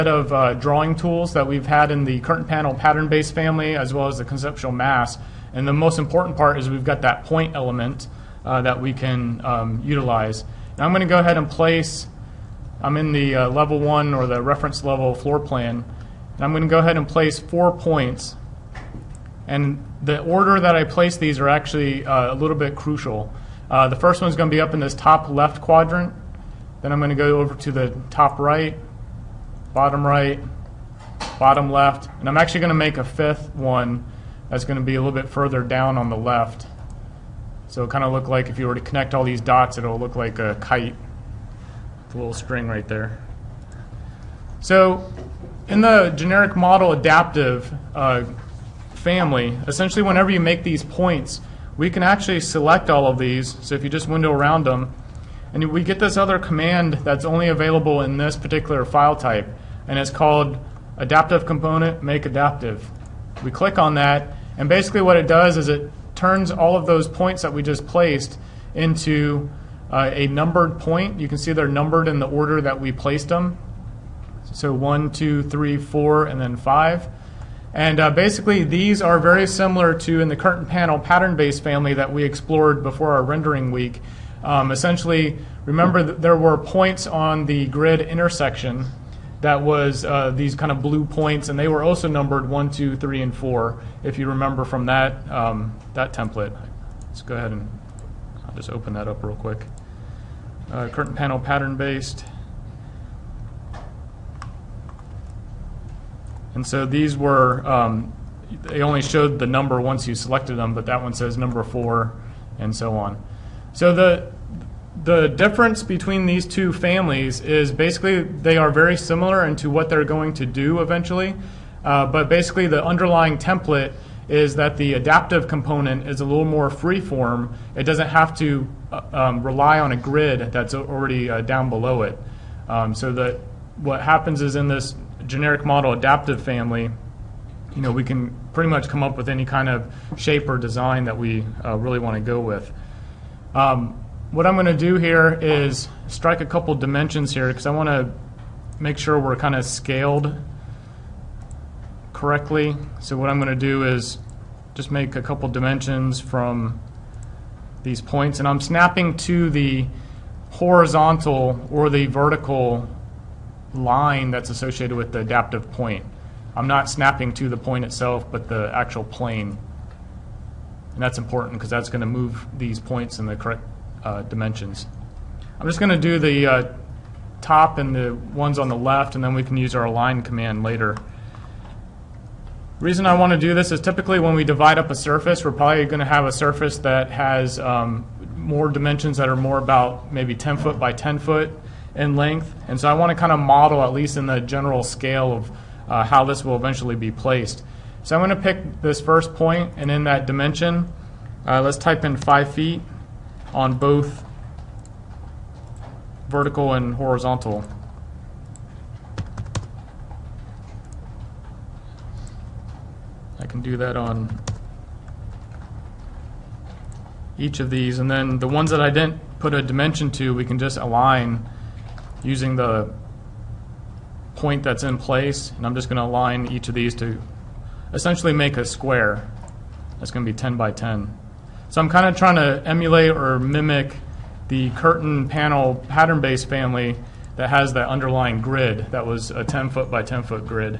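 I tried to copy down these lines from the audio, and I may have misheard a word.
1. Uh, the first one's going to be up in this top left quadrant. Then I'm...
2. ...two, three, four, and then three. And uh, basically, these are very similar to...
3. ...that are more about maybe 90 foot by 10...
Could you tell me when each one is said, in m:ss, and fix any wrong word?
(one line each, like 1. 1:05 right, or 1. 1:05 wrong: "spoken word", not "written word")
1. 0:23 right
2. 1:15 wrong: "five", not "three"
3. 3:09 wrong: "10", not "90".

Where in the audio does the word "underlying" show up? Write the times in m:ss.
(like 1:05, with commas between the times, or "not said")
2:02, 3:57.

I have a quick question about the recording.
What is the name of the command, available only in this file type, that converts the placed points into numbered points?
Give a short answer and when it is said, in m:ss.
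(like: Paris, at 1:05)
Make Adaptive, at 1:02.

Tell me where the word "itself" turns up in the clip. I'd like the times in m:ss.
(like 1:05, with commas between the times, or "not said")
2:47.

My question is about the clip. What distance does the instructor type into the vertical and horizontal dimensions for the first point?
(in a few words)
5 feet.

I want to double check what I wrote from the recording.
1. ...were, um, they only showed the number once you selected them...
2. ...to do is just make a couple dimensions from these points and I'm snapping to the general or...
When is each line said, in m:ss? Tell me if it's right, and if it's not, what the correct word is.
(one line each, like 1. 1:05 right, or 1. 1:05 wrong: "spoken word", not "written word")
1. 1:47 right
2. 2:33 wrong: "horizontal", not "general".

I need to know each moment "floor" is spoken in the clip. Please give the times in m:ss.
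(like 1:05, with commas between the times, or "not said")
0:15.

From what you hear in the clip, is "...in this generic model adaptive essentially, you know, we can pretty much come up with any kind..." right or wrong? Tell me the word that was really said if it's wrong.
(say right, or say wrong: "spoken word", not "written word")
wrong: "family", not "essentially".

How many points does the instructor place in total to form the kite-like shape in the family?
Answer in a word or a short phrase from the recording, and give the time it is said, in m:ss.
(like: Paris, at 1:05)
5, at 0:33.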